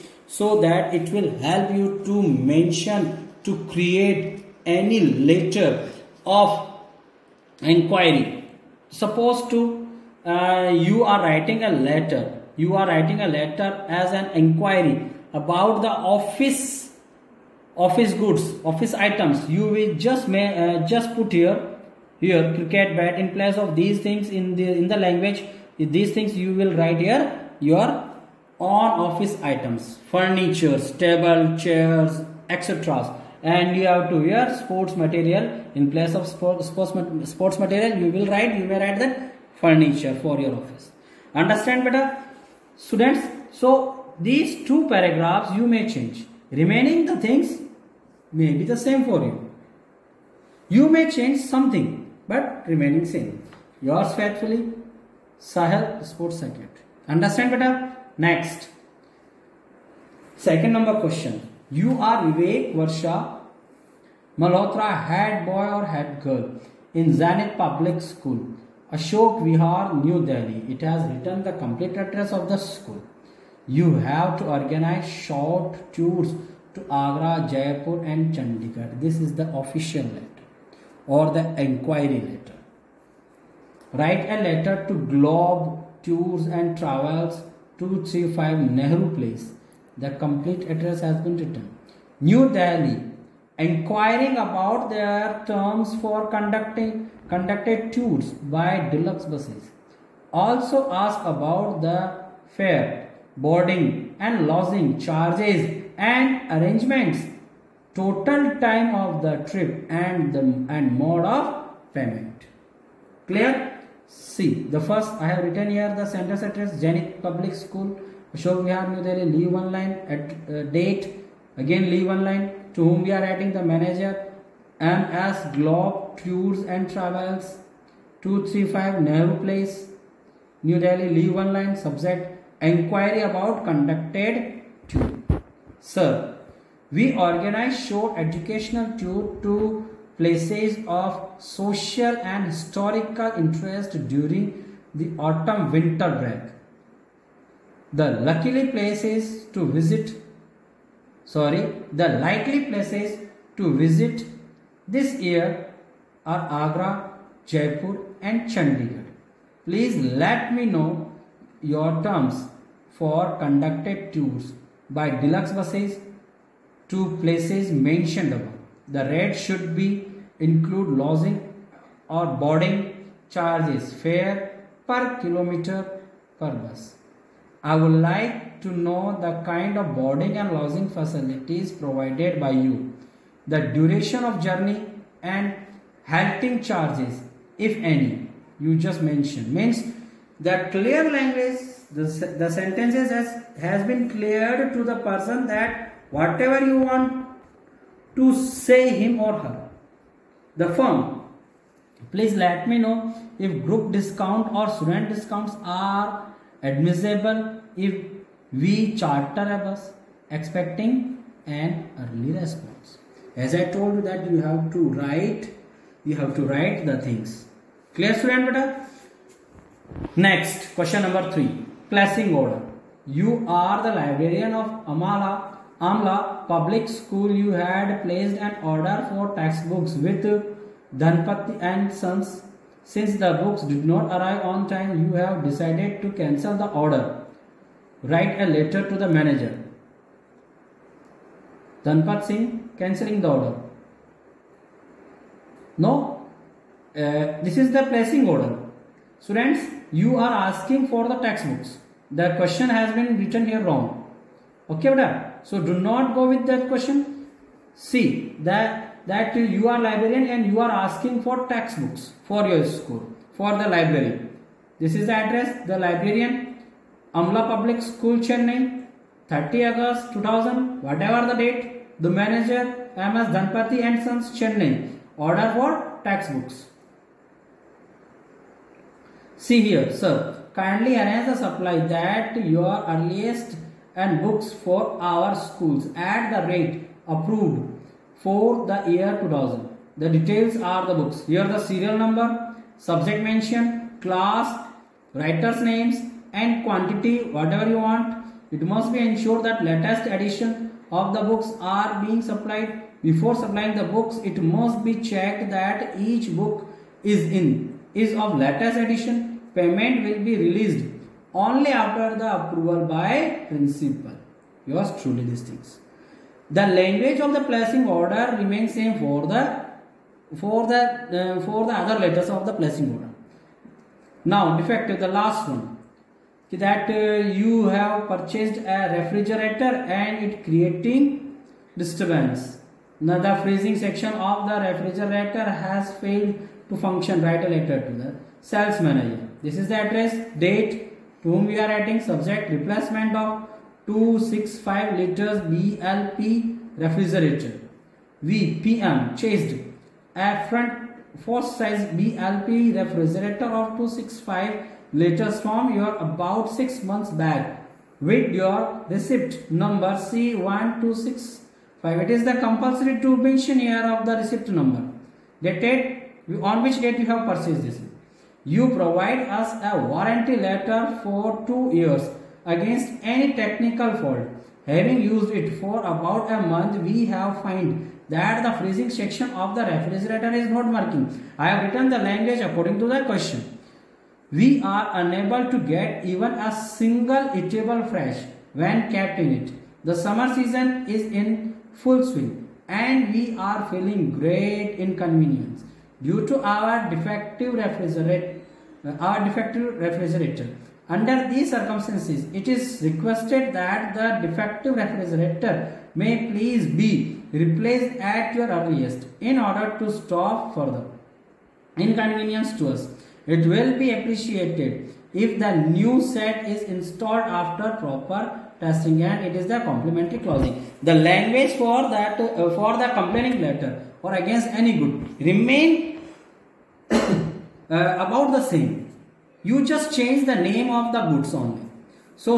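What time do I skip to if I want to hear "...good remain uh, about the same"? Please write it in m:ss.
7:04.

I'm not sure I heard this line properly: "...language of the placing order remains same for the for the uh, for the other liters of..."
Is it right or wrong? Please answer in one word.
wrong.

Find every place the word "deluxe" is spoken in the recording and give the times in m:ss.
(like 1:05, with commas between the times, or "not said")
1:38, 2:45.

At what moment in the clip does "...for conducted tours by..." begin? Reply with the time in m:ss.
2:42.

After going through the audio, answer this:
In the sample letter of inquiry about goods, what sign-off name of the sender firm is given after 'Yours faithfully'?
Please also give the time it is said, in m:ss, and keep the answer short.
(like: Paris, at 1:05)
Sahil Sports Circuit, at 0:55.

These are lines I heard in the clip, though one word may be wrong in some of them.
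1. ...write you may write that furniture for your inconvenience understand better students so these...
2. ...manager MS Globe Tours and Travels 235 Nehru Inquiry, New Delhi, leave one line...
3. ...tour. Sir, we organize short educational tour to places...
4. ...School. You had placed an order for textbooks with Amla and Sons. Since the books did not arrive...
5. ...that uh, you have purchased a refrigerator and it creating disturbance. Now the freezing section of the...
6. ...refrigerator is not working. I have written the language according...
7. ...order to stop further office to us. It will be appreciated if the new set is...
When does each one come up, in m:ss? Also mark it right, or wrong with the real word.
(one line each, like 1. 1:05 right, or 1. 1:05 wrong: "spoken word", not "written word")
1. 0:38 wrong: "office", not "inconvenience"
2. 2:03 wrong: "Place", not "Inquiry"
3. 2:14 right
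4. 3:46 wrong: "Dhanpati", not "Amla"
5. 5:26 right
6. 6:19 right
7. 6:49 wrong: "inconvenience", not "office".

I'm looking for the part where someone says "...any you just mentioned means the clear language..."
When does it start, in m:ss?
3:07.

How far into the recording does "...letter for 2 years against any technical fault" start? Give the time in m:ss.
6:10.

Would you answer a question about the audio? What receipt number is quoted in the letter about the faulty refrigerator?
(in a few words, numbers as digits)
C1265.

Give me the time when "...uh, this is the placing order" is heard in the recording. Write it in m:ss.
4:06.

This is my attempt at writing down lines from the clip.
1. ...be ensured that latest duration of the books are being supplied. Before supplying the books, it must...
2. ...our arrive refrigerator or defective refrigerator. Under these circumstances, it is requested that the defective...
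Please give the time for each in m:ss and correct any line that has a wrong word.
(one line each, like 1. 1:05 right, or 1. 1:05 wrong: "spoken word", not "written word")
1. 4:58 wrong: "edition", not "duration"
2. 6:36 wrong: "defective", not "arrive".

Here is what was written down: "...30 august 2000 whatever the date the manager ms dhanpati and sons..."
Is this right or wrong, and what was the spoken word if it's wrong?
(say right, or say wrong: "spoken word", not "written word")
right.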